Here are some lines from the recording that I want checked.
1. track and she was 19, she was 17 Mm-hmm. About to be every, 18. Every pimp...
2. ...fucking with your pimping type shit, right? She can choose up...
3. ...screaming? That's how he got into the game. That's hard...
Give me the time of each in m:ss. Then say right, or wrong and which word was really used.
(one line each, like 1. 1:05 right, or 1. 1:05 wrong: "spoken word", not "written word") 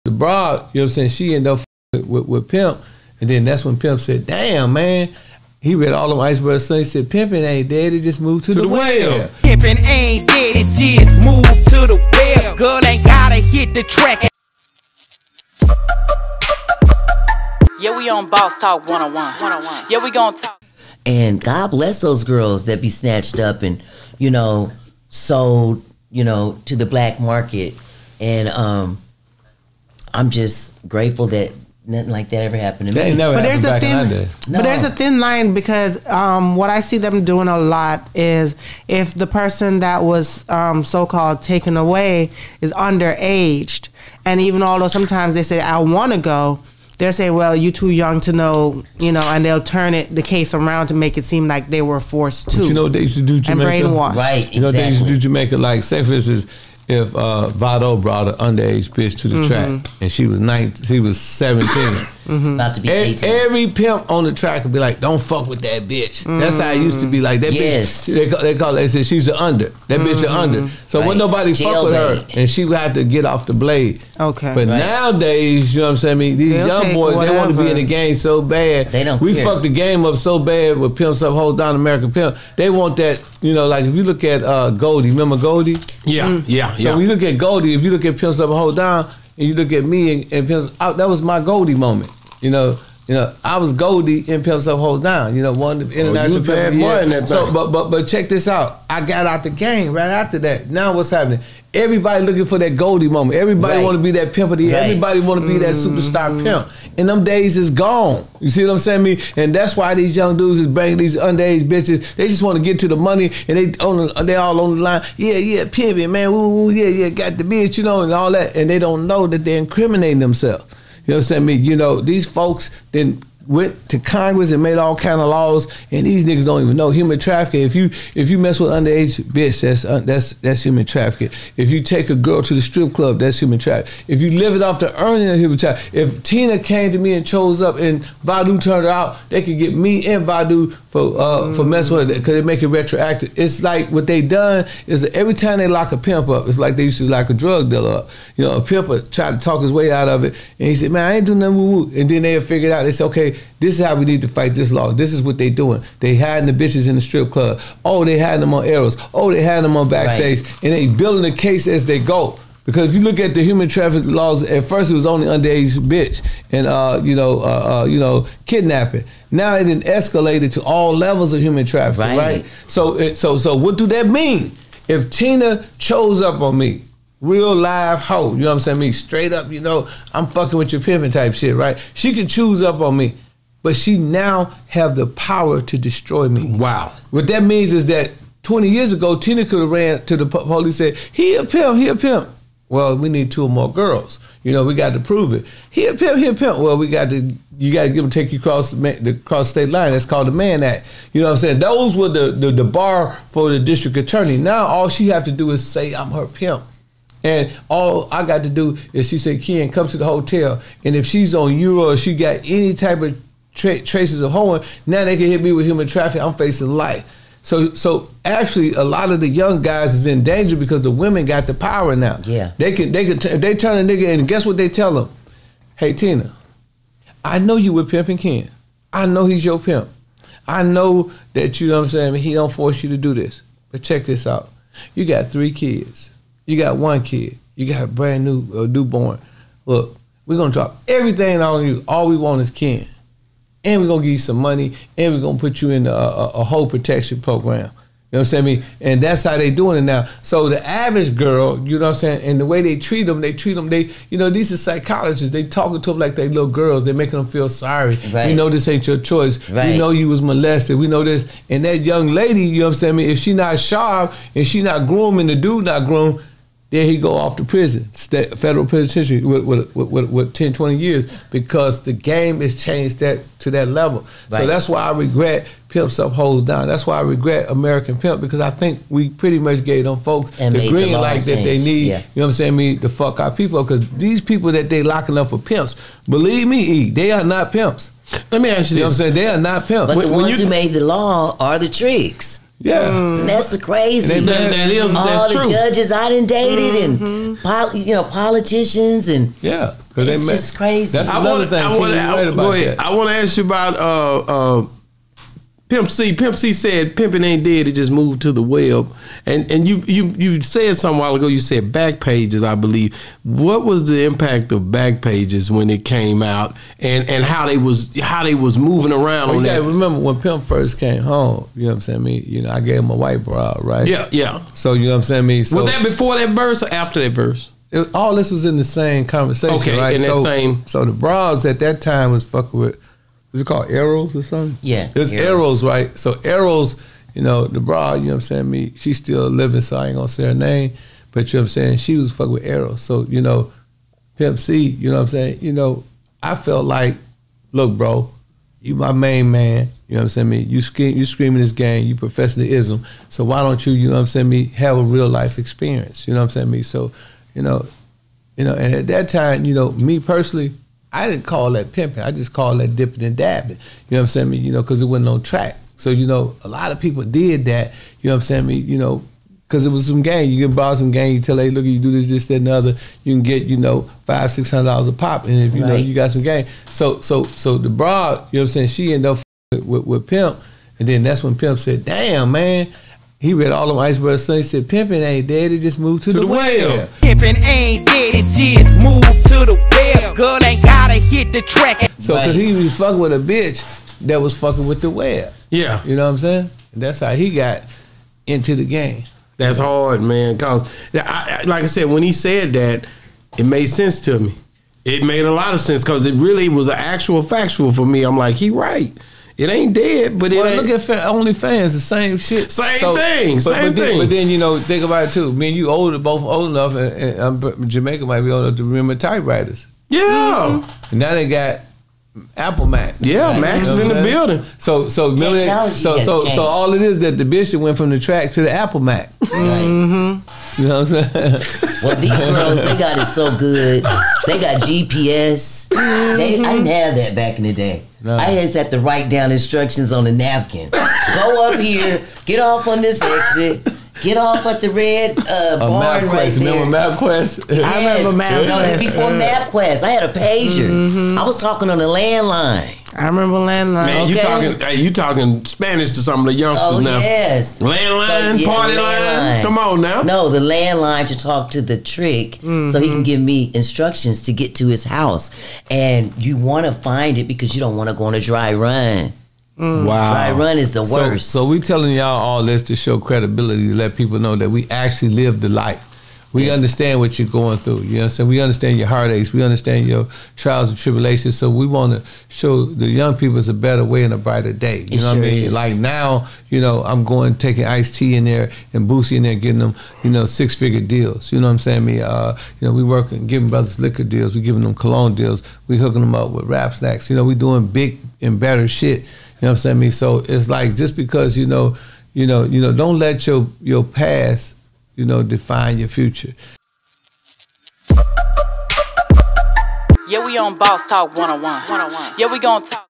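1. 0:59 right
2. 3:00 right
3. 6:36 wrong: "saying", not "screaming".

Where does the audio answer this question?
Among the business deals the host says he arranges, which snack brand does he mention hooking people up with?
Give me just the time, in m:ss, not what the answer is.
8:16.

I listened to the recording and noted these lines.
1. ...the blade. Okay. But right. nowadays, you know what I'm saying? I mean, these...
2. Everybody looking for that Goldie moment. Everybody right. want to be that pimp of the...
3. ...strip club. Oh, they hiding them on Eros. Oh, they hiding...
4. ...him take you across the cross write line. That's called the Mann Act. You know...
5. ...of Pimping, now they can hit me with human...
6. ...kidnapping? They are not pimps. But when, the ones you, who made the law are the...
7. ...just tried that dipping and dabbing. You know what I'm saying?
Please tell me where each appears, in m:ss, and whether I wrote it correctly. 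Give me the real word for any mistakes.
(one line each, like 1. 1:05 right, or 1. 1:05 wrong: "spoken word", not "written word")
1. 1:13 right
2. 1:41 right
3. 2:37 right
4. 3:18 wrong: "state", not "write"
5. 3:34 wrong: "hoeing", not "Pimping"
6. 4:49 wrong: "saying", not "kidnapping"
7. 6:02 wrong: "called", not "tried".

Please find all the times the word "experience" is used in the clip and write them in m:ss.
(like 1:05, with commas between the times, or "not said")
5:55.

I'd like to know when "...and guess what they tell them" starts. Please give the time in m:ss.
3:44.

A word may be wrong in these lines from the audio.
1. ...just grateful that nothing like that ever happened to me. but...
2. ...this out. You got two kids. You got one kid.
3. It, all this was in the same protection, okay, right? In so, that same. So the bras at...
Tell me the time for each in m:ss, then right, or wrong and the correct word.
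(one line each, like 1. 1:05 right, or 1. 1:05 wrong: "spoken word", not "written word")
1. 0:30 right
2. 3:54 wrong: "three", not "two"
3. 5:27 wrong: "conversation", not "protection".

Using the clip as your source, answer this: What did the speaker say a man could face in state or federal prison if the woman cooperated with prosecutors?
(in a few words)
10 to 20 years.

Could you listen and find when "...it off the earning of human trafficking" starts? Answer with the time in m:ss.
2:14.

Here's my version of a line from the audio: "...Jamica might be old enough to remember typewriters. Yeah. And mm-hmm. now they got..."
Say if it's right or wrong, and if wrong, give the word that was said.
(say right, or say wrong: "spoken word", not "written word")
right.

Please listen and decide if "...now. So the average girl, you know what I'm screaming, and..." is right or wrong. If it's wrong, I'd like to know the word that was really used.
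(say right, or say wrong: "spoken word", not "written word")
wrong: "saying", not "screaming".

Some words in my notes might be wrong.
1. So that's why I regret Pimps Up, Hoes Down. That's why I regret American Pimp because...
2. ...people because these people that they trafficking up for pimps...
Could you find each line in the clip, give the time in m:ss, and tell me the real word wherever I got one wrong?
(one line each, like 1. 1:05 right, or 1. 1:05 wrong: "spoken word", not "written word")
1. 4:34 right
2. 4:43 wrong: "locking", not "trafficking".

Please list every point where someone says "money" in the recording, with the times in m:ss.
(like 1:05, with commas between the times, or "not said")
1:52, 4:04.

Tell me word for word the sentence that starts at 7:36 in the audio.
Yes, landline, so, yeah, party landline.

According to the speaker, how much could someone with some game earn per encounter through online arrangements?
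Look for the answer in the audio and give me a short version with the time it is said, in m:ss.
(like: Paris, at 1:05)
500-600 dollars, at 6:14.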